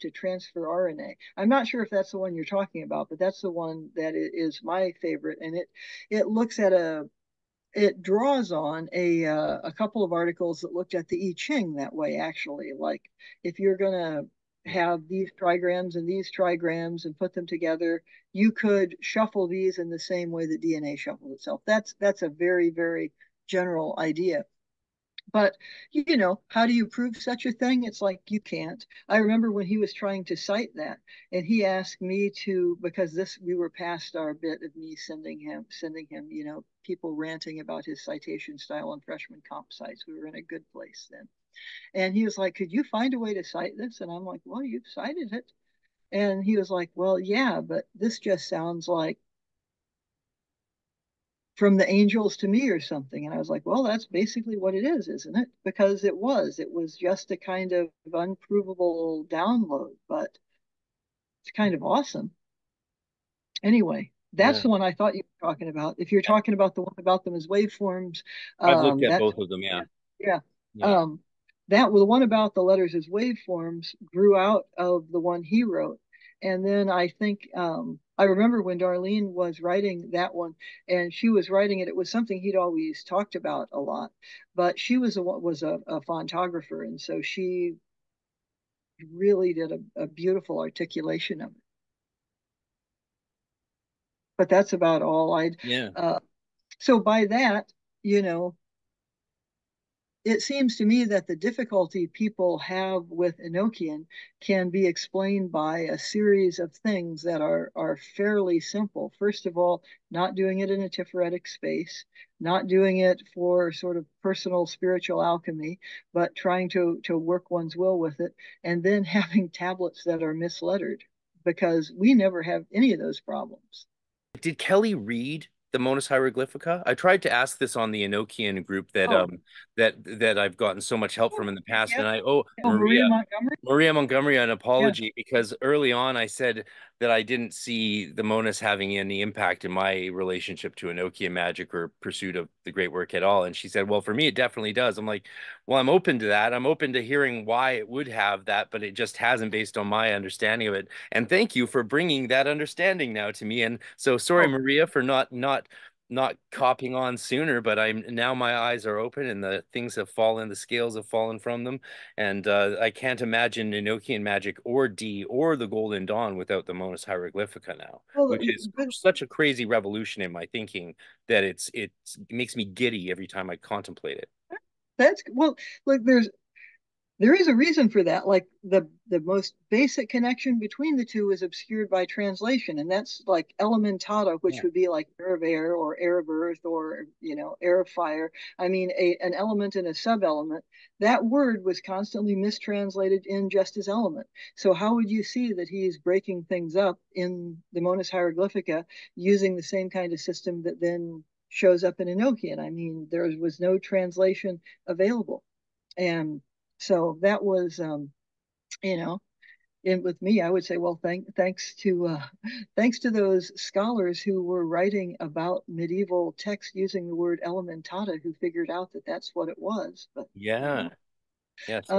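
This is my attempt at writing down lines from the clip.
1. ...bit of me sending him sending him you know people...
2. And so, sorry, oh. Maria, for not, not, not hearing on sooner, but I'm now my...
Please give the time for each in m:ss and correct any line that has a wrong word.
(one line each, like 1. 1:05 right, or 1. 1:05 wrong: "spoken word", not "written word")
1. 0:34 right
2. 2:33 wrong: "copying", not "hearing".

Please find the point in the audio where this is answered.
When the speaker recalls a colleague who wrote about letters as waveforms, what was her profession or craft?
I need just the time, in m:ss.
1:26.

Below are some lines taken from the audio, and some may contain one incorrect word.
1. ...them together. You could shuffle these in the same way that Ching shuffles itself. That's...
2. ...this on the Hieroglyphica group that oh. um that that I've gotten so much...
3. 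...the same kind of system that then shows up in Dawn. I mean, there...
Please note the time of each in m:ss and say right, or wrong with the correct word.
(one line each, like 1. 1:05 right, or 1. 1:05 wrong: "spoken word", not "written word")
1. 0:17 wrong: "DNA", not "Ching"
2. 2:07 wrong: "Enochian", not "Hieroglyphica"
3. 3:19 wrong: "Enochian", not "Dawn".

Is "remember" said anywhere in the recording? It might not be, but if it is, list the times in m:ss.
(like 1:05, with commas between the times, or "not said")
0:29, 1:18.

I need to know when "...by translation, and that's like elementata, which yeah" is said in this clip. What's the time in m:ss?
3:01.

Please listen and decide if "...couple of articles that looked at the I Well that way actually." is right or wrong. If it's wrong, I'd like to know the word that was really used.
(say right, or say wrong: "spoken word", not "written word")
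wrong: "Ching", not "Well".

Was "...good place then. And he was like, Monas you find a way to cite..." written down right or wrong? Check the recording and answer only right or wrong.
wrong.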